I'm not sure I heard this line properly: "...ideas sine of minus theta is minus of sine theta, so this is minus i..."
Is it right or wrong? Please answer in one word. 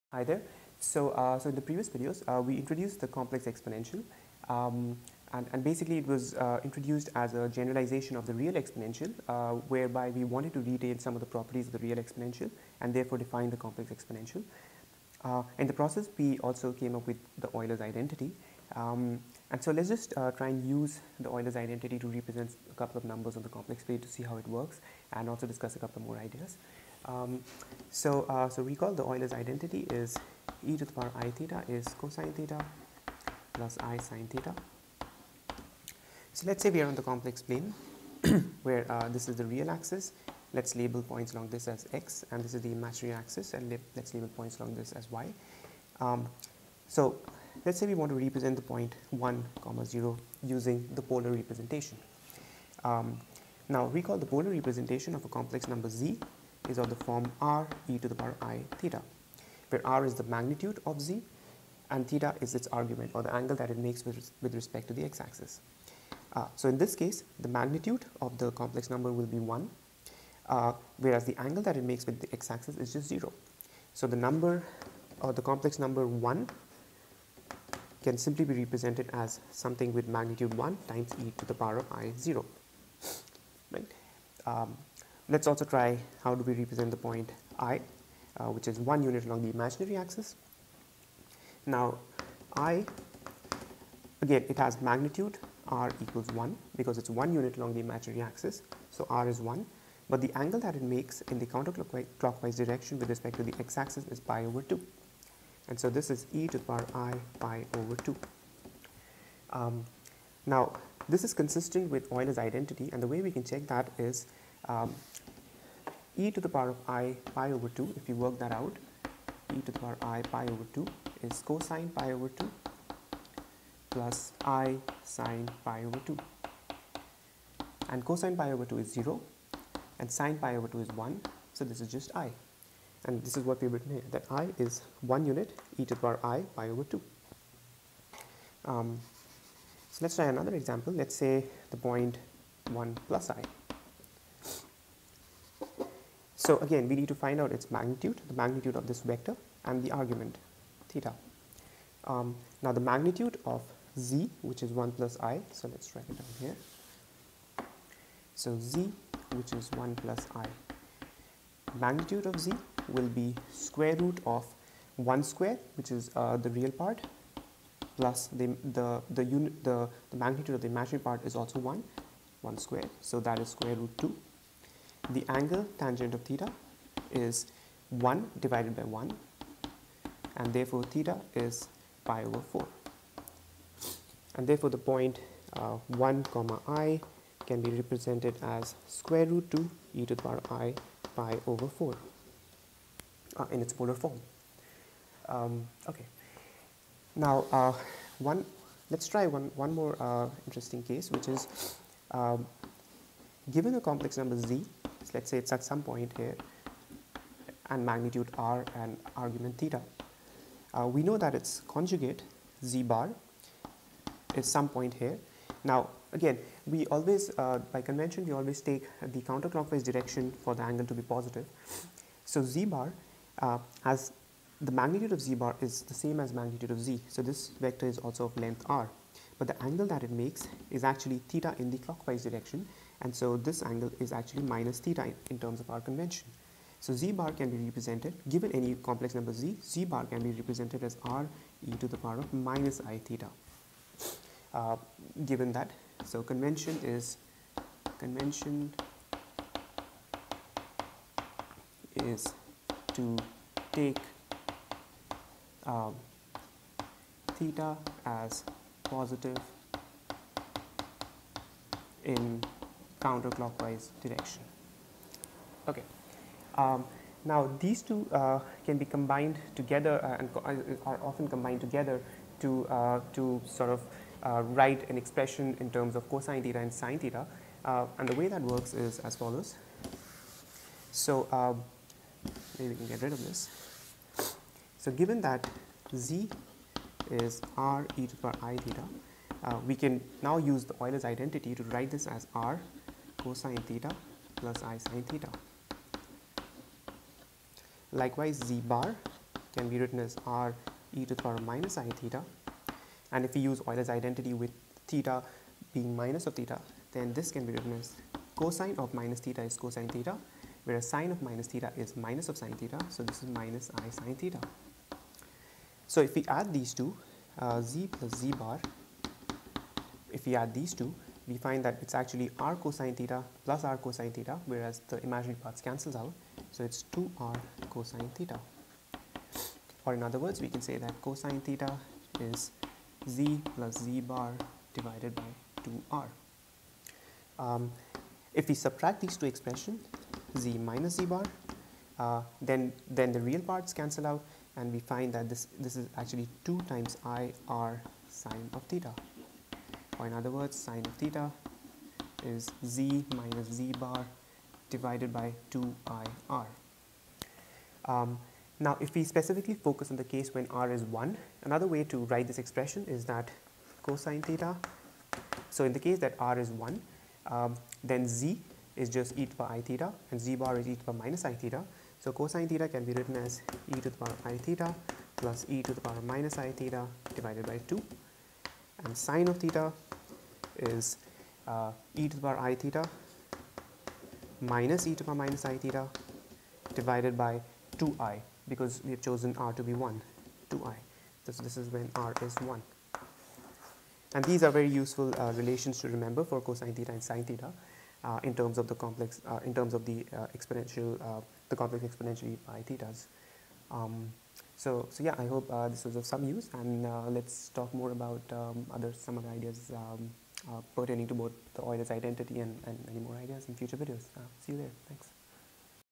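wrong.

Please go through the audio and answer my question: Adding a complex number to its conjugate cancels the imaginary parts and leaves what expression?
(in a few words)
2r cosine theta.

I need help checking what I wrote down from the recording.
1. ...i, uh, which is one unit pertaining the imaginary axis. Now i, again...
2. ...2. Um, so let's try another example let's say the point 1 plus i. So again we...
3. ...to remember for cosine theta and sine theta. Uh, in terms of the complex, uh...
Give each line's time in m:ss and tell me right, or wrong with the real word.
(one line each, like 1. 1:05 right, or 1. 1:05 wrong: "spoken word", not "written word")
1. 1:27 wrong: "along", not "pertaining"
2. 2:16 right
3. 6:35 right.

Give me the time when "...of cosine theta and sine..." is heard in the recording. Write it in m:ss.
4:35.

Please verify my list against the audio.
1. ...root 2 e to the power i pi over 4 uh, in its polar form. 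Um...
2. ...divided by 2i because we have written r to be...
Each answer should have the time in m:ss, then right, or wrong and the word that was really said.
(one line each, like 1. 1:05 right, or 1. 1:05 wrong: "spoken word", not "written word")
1. 3:09 right
2. 6:26 wrong: "chosen", not "written".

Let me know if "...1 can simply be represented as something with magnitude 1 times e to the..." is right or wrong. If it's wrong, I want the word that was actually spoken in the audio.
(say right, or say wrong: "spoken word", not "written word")
right.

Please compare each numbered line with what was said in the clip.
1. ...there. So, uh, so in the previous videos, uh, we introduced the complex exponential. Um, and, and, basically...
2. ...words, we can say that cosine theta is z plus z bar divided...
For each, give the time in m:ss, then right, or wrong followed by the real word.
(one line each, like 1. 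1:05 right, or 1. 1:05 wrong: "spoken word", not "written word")
1. 0:00 right
2. 5:30 right.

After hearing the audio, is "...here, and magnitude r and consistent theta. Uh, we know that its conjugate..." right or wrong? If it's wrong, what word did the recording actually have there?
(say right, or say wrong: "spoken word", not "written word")
wrong: "argument", not "consistent".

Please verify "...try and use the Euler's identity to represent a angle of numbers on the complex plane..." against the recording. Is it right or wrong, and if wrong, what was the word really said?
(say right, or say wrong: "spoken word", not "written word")
wrong: "couple", not "angle".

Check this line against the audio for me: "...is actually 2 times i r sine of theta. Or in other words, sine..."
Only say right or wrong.
right.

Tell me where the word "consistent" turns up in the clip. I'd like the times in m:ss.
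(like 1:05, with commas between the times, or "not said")
1:51.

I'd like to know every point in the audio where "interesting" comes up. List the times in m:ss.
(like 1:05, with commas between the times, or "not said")
3:20.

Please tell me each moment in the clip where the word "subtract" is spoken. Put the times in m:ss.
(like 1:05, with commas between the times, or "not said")
5:38.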